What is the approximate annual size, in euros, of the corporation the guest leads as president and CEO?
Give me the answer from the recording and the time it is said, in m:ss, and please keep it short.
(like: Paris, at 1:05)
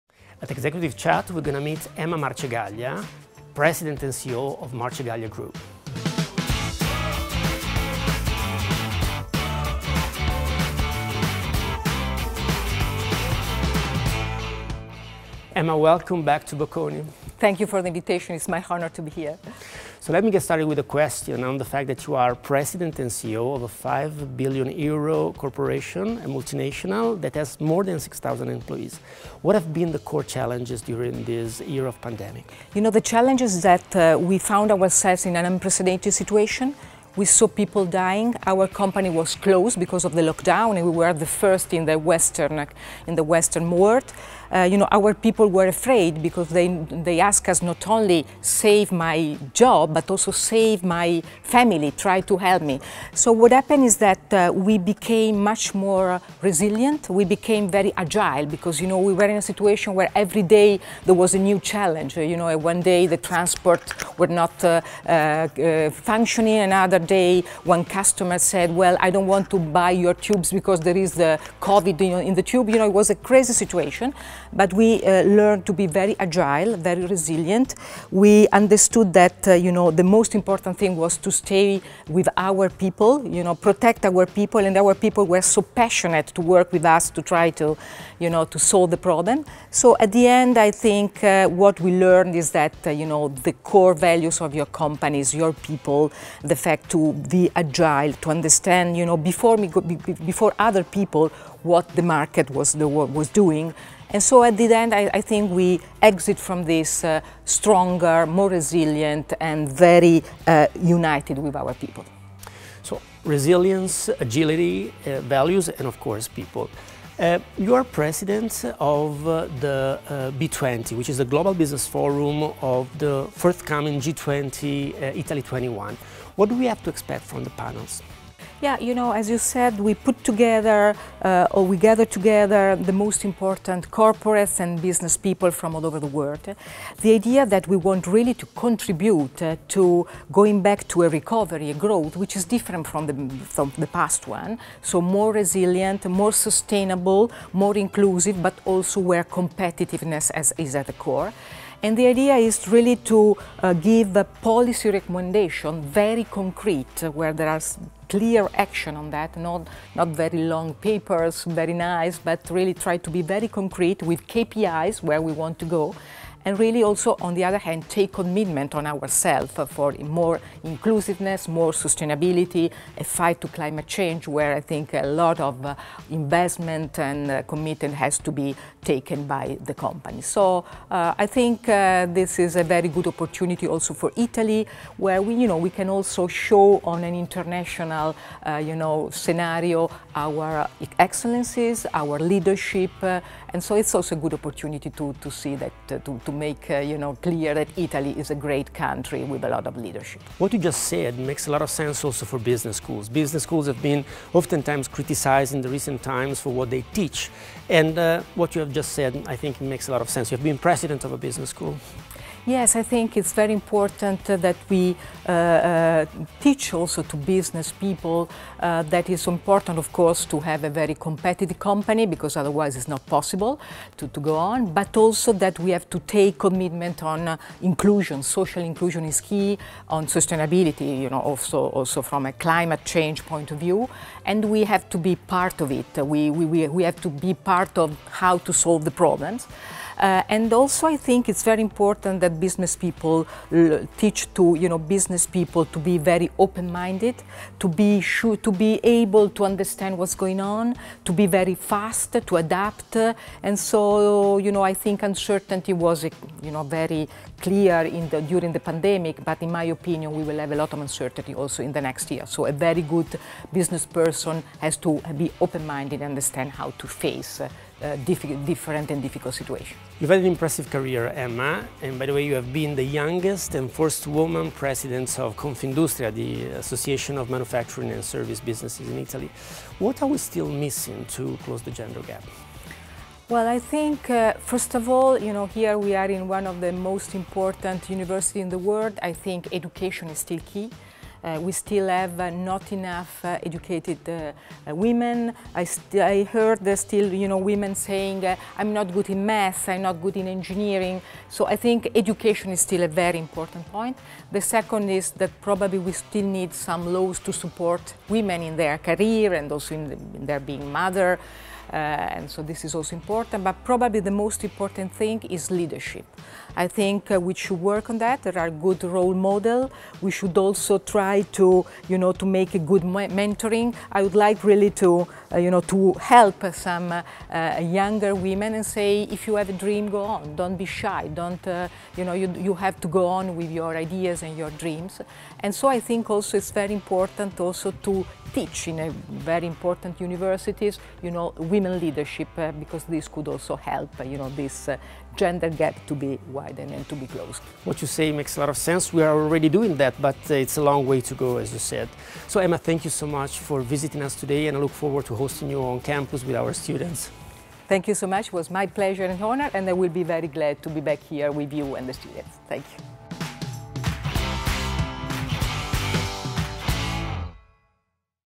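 5 billion euros, at 0:23.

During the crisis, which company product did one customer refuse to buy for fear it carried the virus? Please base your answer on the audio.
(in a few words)
Tubes.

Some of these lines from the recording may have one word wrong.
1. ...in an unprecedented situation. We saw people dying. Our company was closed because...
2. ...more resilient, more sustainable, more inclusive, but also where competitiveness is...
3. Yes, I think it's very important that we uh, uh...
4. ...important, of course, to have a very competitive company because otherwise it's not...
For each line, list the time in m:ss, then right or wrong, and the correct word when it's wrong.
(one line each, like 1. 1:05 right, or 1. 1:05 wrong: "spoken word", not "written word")
1. 0:35 right
2. 2:25 right
3. 3:32 right
4. 3:39 right.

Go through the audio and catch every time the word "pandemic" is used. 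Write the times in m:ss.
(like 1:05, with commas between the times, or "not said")
0:32, 4:18.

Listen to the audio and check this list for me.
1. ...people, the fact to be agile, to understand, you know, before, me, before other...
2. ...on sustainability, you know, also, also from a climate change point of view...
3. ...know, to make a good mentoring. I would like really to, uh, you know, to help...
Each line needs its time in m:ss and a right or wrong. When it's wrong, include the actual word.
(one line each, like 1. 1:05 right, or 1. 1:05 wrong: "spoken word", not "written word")
1. 1:35 right
2. 3:49 right
3. 5:21 right.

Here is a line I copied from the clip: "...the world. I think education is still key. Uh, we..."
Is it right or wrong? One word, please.
right.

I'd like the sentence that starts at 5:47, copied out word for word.
What you say makes a lot of sense.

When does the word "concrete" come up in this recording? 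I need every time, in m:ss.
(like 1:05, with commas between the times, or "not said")
2:36, 2:43.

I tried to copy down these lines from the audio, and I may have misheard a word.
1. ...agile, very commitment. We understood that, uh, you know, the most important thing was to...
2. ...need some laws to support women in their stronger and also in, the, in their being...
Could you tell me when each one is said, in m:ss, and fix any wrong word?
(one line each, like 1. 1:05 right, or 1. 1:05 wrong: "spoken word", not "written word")
1. 1:16 wrong: "resilient", not "commitment"
2. 5:06 wrong: "career", not "stronger".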